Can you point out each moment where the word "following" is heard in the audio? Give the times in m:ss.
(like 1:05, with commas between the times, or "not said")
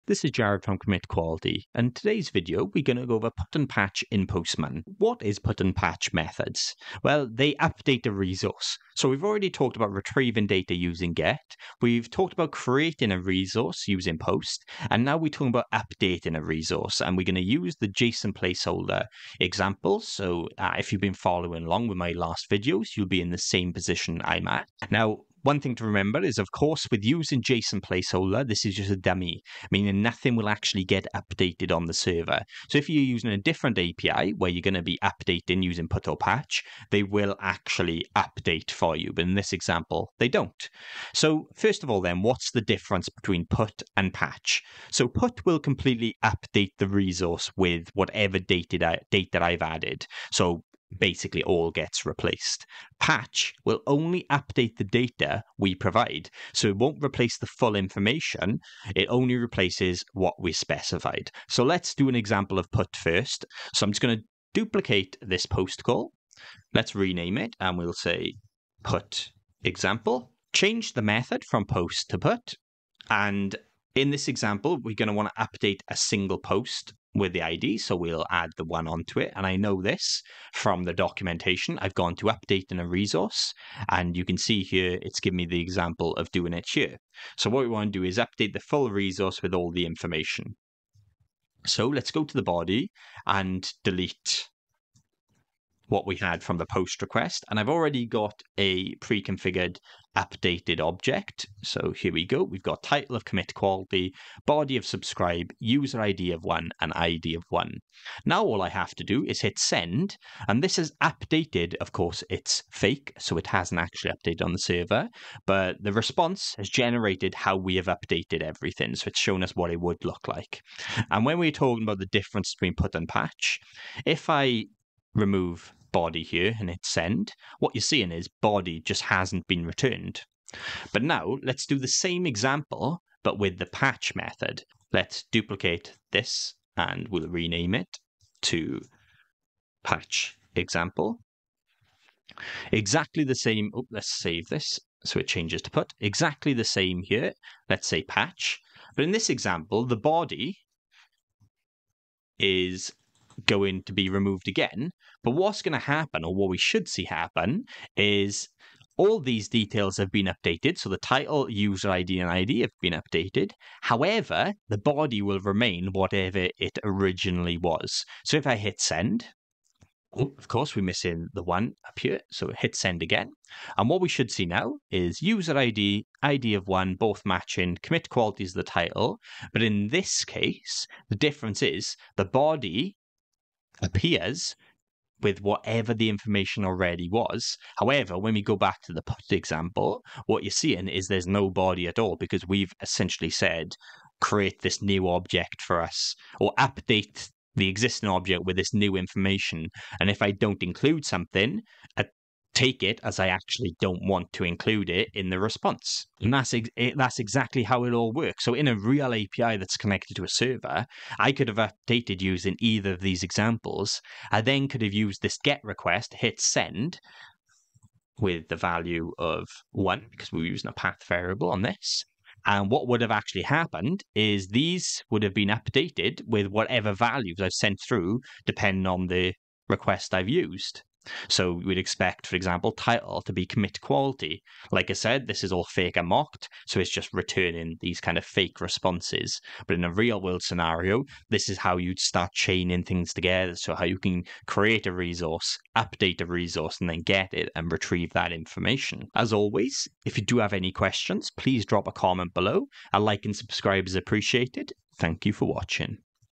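0:21.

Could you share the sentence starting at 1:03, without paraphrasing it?
So I'm just going to duplicate this post call.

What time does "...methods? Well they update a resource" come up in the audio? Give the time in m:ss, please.
0:06.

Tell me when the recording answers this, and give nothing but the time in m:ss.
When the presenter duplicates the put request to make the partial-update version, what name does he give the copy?
2:19.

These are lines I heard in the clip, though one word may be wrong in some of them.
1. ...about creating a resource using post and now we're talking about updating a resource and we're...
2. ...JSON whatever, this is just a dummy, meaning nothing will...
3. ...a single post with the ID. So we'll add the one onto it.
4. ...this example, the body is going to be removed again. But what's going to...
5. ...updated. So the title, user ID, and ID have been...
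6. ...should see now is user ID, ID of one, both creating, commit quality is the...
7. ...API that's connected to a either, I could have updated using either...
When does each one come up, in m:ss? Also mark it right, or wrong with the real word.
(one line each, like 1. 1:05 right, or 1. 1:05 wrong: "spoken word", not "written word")
1. 0:12 right
2. 0:27 wrong: "placeholder", not "whatever"
3. 1:15 right
4. 2:29 right
5. 2:40 right
6. 2:54 wrong: "matching", not "creating"
7. 3:29 wrong: "server", not "either".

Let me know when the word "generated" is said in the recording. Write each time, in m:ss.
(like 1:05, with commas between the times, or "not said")
1:56.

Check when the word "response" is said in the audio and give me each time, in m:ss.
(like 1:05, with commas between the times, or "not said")
1:55, 3:25, 3:58.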